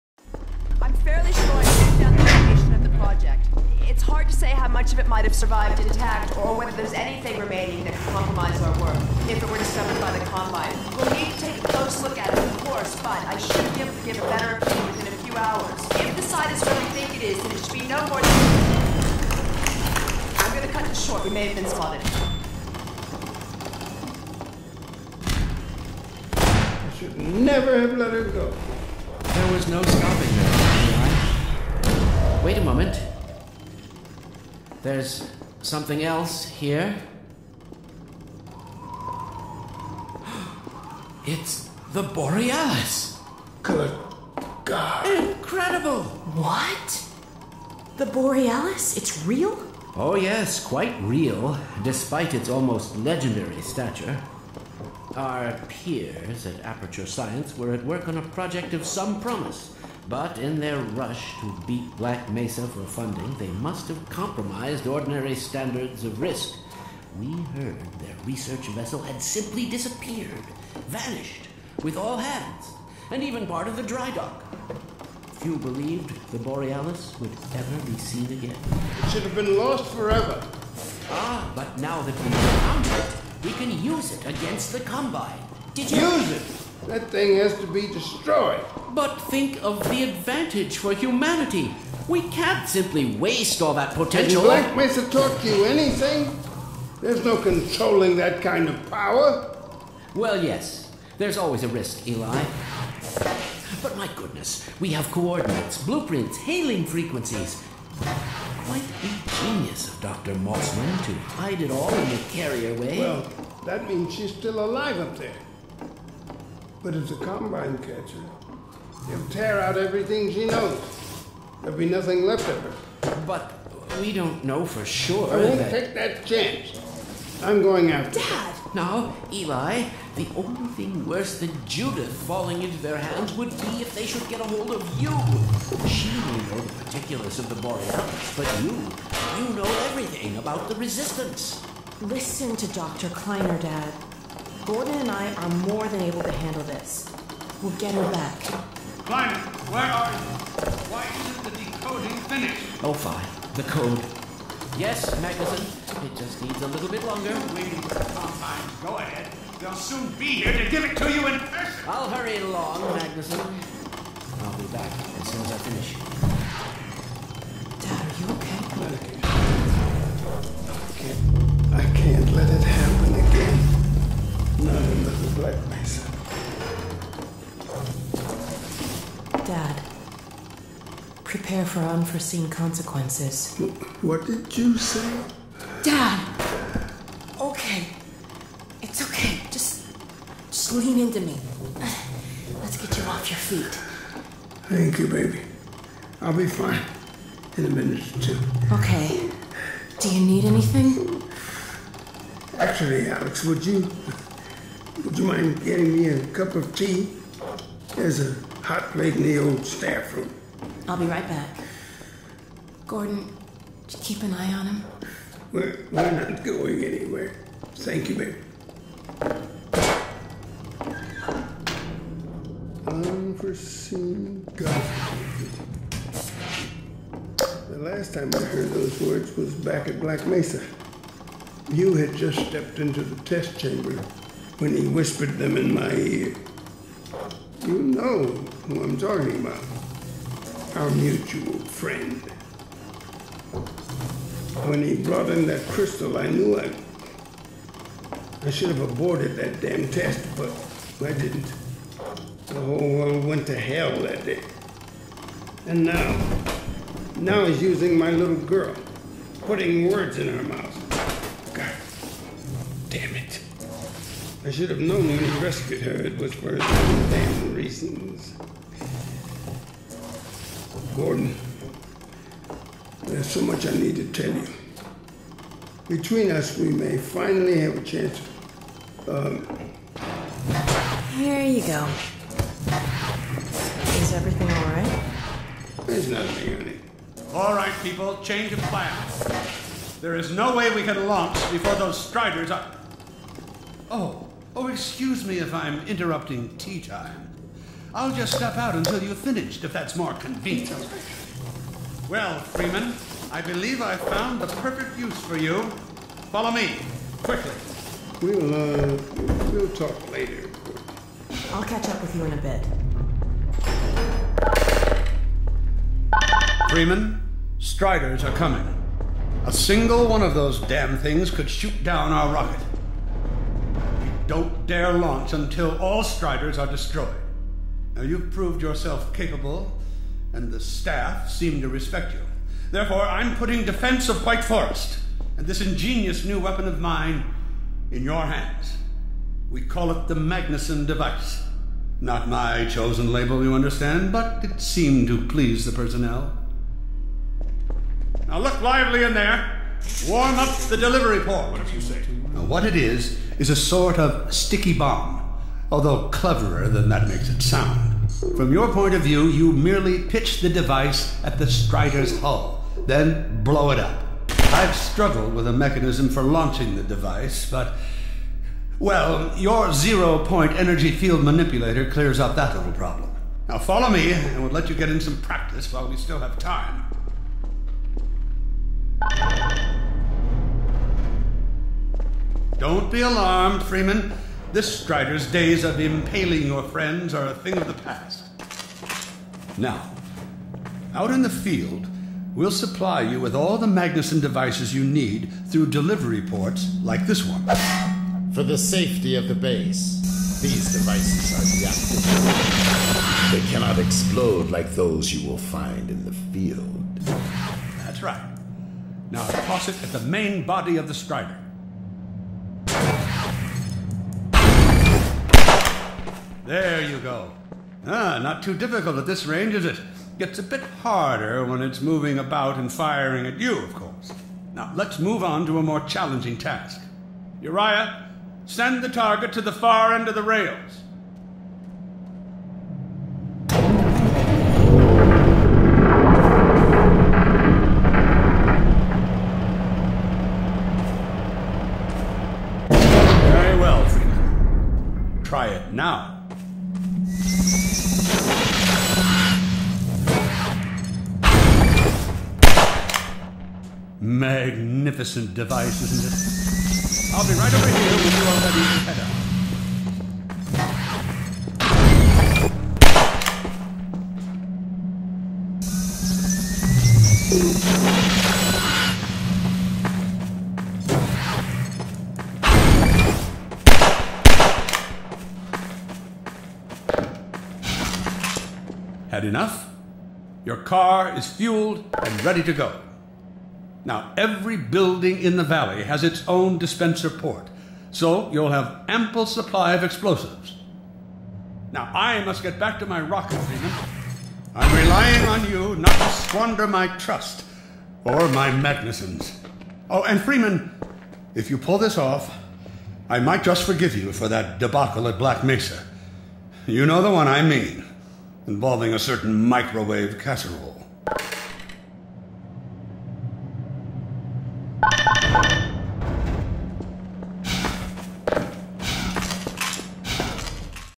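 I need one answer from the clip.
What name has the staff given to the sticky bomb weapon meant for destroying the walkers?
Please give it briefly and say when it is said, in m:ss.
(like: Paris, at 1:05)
Magnusson device, at 5:40.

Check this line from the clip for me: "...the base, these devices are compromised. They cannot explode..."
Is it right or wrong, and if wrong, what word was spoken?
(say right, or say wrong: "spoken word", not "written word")
wrong: "deactivated", not "compromised".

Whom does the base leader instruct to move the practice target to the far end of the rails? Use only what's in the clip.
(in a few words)
Uriah.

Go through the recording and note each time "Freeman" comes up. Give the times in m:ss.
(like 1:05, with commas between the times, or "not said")
5:02, 5:16, 6:23, 7:23, 8:13, 8:20.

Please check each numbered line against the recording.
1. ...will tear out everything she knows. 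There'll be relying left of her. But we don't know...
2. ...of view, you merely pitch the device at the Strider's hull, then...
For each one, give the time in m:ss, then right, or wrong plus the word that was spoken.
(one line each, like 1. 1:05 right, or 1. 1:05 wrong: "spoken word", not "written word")
1. 1:59 wrong: "nothing", not "relying"
2. 5:58 right.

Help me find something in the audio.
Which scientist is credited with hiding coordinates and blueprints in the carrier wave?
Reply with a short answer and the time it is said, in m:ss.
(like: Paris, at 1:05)
Dr. Mossman, at 1:50.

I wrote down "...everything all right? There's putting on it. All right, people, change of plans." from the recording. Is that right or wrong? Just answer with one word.
wrong.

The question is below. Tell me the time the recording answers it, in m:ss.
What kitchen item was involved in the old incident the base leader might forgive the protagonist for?
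8:29.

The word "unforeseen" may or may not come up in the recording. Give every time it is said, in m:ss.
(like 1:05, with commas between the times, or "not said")
3:01, 3:42.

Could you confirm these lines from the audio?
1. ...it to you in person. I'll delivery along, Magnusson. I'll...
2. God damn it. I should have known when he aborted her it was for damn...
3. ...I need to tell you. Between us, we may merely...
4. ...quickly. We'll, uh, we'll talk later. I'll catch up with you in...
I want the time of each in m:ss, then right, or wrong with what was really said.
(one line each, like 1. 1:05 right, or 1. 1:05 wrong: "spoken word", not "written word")
1. 2:40 wrong: "hurry", not "delivery"
2. 4:21 wrong: "rescued", not "aborted"
3. 4:33 wrong: "finally", not "merely"
4. 5:07 right.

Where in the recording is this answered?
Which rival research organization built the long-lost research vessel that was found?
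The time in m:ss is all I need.
0:56.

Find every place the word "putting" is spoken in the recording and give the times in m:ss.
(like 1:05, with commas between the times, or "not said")
4:19, 5:33.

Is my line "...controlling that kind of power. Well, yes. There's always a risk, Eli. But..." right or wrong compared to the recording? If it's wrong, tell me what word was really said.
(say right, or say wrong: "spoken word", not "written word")
right.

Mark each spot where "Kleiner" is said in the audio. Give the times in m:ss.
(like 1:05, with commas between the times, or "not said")
2:23, 2:29.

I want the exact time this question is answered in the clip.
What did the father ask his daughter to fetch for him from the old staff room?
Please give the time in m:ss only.
3:26.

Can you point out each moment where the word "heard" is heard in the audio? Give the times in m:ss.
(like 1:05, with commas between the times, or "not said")
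1:07, 3:48.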